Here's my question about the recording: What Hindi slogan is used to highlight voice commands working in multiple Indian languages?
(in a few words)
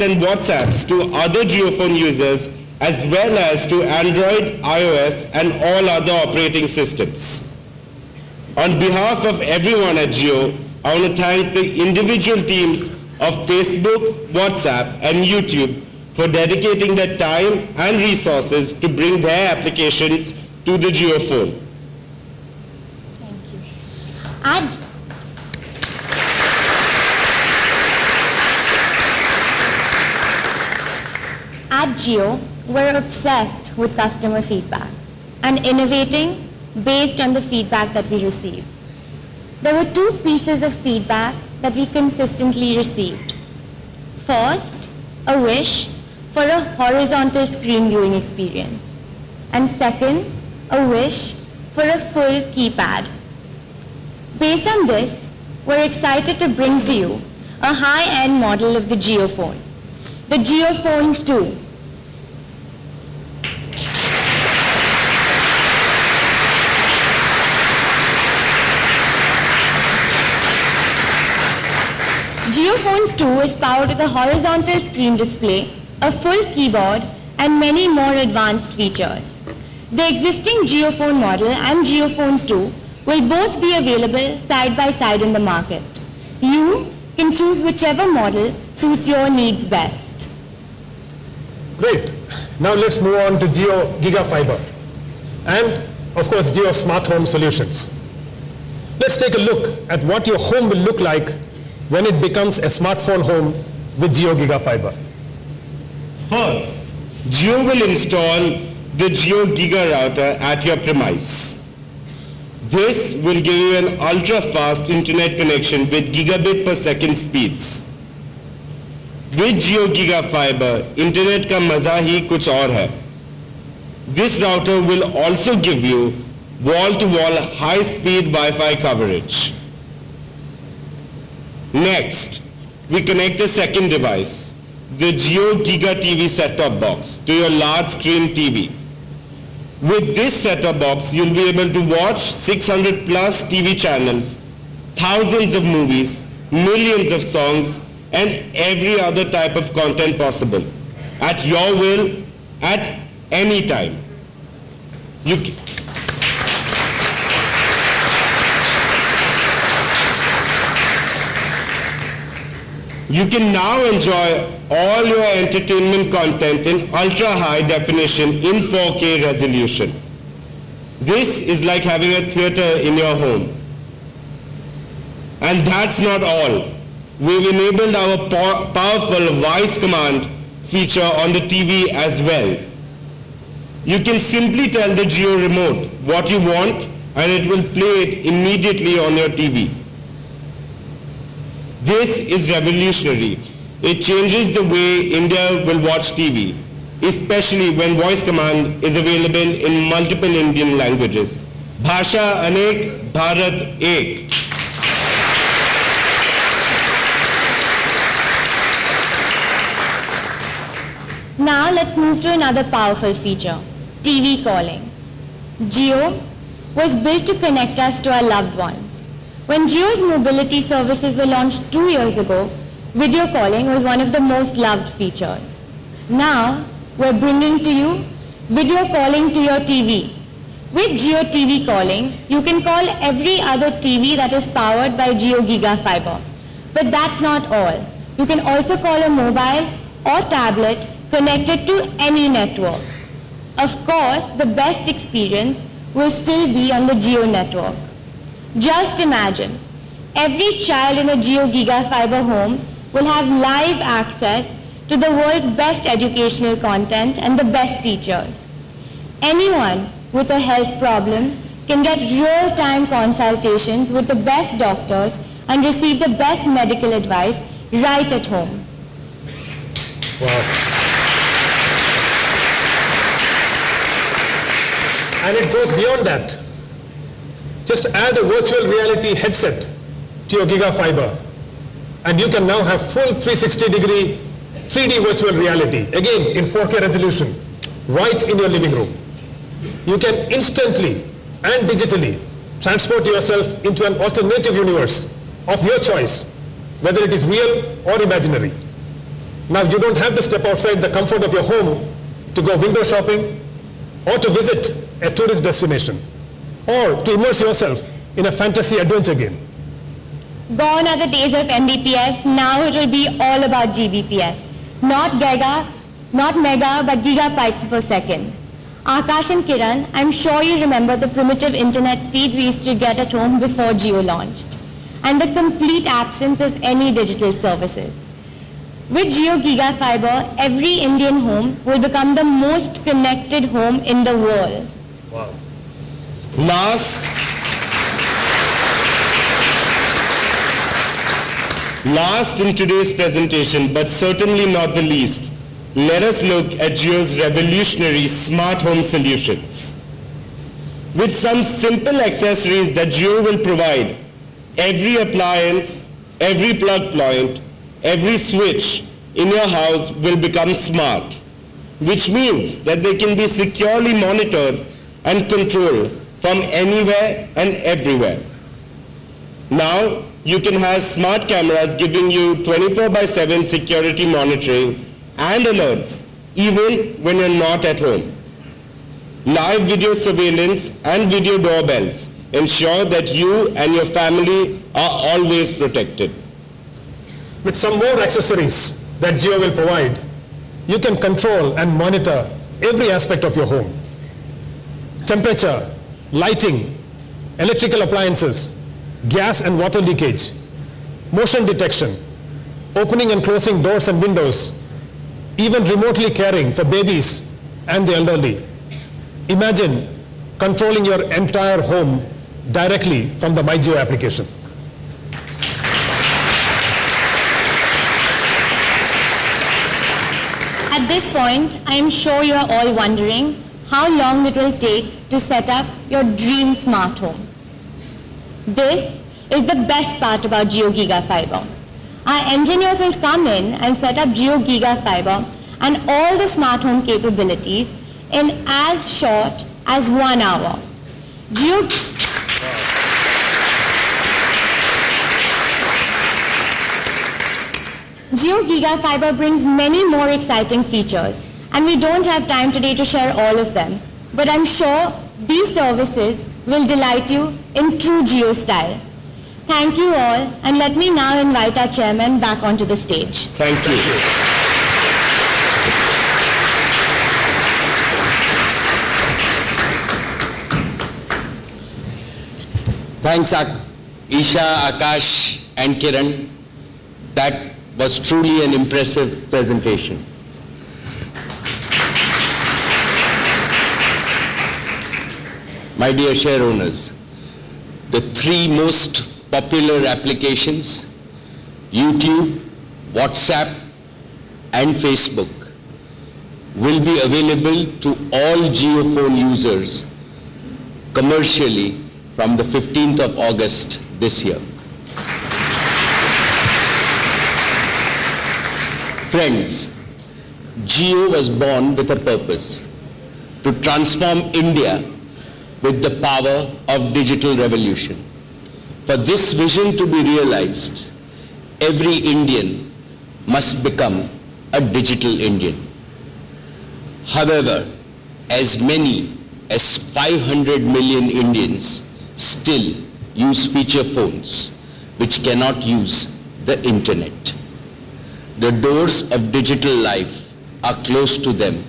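Bhasha Anek, Bharat Ek.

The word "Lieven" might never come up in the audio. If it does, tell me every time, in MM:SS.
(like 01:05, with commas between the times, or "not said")
not said.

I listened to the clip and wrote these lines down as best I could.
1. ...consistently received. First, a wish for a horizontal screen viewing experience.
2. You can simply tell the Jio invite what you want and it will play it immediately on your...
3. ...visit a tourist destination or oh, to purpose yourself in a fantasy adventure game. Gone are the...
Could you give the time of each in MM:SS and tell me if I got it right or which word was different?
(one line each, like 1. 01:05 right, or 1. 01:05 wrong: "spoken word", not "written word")
1. 00:41 right
2. 03:03 wrong: "remote", not "invite"
3. 05:04 wrong: "immerse", not "purpose".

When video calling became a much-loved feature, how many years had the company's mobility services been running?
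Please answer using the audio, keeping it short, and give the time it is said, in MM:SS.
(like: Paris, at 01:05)
2, at 03:41.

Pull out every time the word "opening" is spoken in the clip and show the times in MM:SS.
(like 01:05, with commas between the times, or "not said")
06:42.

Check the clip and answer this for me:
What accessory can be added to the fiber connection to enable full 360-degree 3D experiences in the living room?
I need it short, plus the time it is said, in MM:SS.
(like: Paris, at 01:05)
Virtual reality headset, at 04:38.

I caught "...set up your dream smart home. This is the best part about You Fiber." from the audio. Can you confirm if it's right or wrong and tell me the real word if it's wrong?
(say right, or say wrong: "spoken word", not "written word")
wrong: "JioGiga", not "You".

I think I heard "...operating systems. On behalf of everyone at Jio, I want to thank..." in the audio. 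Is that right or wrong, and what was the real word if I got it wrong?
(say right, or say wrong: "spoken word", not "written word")
right.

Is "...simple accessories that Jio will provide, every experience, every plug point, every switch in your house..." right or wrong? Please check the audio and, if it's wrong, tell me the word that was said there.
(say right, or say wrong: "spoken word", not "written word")
wrong: "appliance", not "experience".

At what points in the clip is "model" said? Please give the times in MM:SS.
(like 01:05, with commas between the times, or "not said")
00:58, 01:21, 01:28.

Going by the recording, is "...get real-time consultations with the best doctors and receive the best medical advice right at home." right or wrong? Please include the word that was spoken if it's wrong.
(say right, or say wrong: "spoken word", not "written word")
right.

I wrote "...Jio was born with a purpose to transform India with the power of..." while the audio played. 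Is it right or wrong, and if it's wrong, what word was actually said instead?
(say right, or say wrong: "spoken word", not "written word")
right.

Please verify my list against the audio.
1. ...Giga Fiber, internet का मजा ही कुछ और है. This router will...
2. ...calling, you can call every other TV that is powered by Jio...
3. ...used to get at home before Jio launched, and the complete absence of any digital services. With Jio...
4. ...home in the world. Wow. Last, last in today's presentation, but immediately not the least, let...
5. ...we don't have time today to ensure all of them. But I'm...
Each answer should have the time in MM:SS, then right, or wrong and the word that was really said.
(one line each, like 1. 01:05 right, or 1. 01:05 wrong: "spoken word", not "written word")
1. 01:59 right
2. 03:51 right
3. 05:22 right
4. 05:33 wrong: "certainly", not "immediately"
5. 07:31 wrong: "share", not "ensure".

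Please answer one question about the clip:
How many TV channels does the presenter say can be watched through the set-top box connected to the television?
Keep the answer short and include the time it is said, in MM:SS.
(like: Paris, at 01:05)
600 plus, at 02:22.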